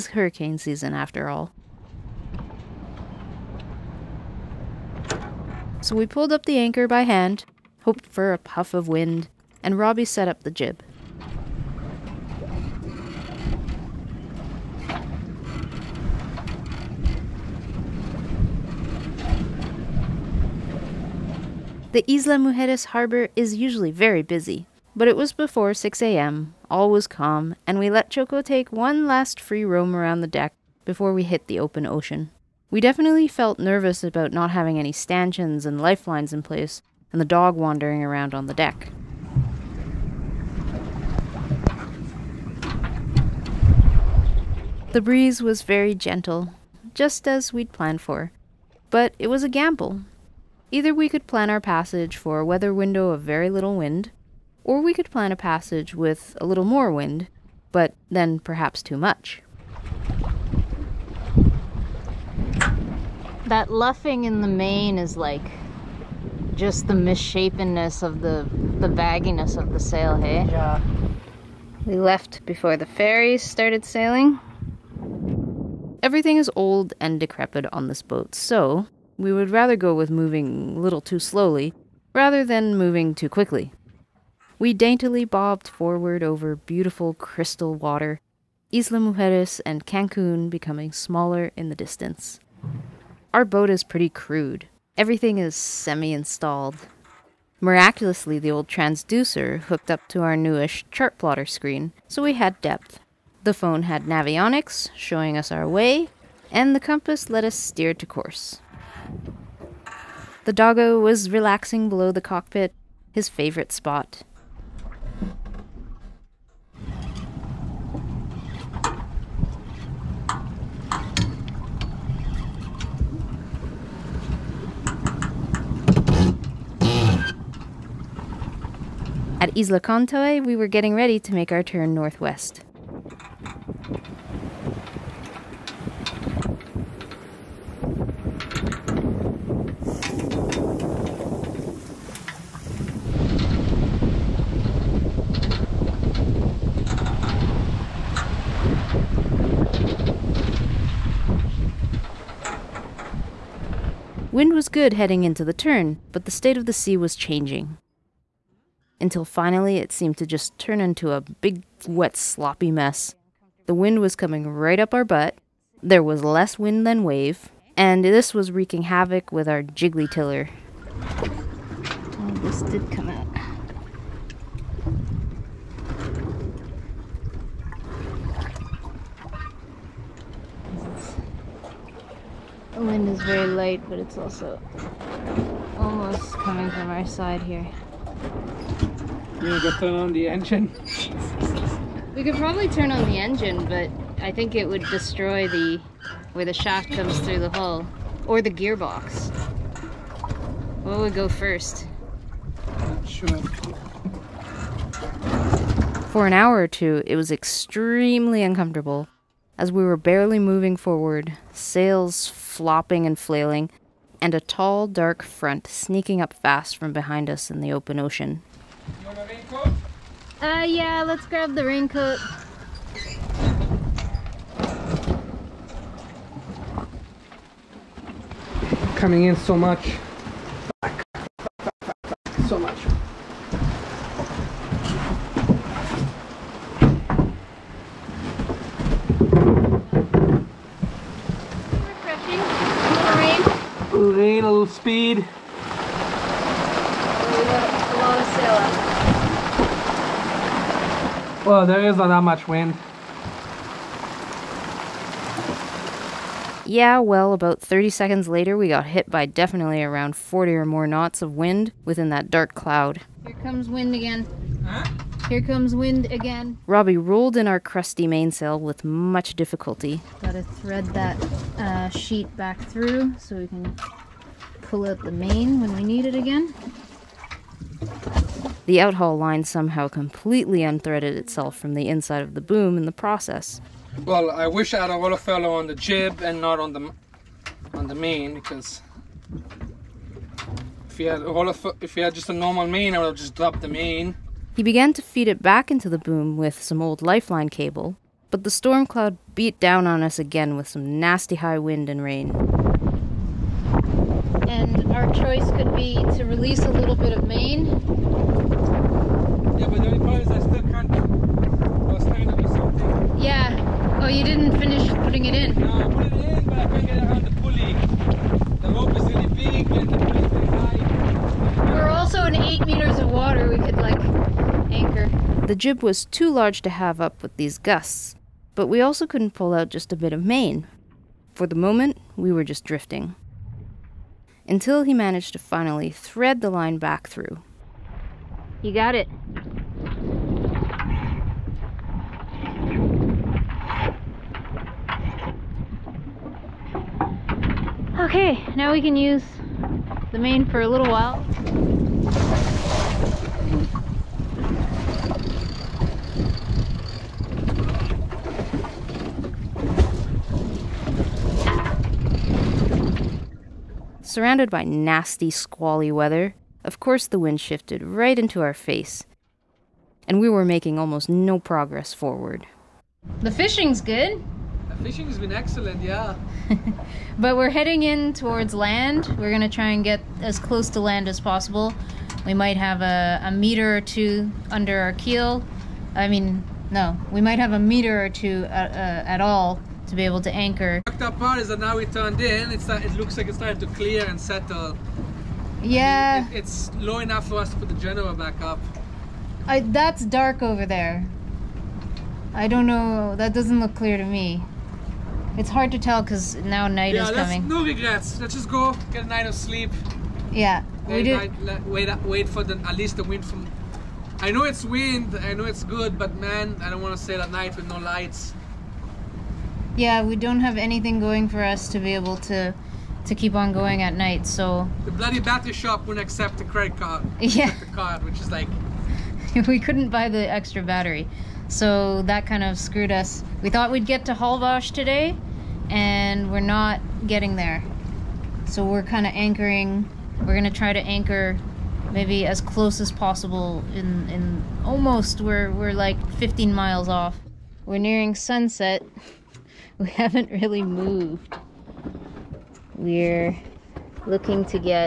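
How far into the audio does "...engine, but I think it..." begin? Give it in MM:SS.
03:13.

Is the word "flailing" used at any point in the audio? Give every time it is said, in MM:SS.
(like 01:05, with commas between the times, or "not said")
03:33.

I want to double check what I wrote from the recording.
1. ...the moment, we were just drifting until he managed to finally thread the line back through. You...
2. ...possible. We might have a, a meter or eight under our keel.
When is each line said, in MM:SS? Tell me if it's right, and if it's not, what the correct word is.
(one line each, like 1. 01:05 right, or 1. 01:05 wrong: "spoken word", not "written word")
1. 05:31 right
2. 06:21 wrong: "two", not "eight".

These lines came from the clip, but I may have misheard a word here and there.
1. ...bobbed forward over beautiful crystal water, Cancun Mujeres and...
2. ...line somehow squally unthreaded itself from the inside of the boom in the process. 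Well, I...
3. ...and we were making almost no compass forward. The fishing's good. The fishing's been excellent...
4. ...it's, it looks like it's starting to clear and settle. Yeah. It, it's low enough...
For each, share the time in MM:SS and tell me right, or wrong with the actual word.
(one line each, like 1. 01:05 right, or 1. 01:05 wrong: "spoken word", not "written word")
1. 01:25 wrong: "Isla", not "Cancun"
2. 04:39 wrong: "completely", not "squally"
3. 06:10 wrong: "progress", not "compass"
4. 06:32 right.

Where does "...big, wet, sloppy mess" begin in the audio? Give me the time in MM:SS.
02:41.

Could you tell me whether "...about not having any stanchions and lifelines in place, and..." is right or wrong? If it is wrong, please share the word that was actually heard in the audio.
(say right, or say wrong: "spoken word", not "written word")
right.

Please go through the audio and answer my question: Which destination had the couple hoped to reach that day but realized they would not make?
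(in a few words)
Holbox.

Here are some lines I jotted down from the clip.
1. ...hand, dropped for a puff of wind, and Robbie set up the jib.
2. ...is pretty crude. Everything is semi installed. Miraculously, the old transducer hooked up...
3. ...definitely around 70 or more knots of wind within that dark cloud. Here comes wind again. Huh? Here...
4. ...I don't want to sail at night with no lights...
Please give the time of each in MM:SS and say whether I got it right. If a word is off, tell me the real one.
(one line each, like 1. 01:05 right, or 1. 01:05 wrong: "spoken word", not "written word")
1. 00:07 wrong: "hoped", not "dropped"
2. 01:33 right
3. 04:19 wrong: "40", not "70"
4. 06:56 right.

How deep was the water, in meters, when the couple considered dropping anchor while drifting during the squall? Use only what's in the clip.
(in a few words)
8 meters.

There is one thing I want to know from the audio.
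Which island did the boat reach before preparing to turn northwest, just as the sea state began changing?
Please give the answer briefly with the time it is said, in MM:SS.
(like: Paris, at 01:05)
Isla Contoy, at 02:09.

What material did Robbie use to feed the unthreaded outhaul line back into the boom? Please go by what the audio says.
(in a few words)
old lifeline cable.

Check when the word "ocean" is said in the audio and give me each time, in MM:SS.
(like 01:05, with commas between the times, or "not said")
00:31, 03:37.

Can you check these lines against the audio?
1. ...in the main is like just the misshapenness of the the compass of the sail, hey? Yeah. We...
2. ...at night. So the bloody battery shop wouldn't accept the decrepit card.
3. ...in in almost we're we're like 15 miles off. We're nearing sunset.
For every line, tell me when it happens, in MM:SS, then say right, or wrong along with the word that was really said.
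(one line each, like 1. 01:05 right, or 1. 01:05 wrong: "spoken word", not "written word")
1. 01:04 wrong: "bagginess", not "compass"
2. 07:03 wrong: "credit", not "decrepit"
3. 07:23 right.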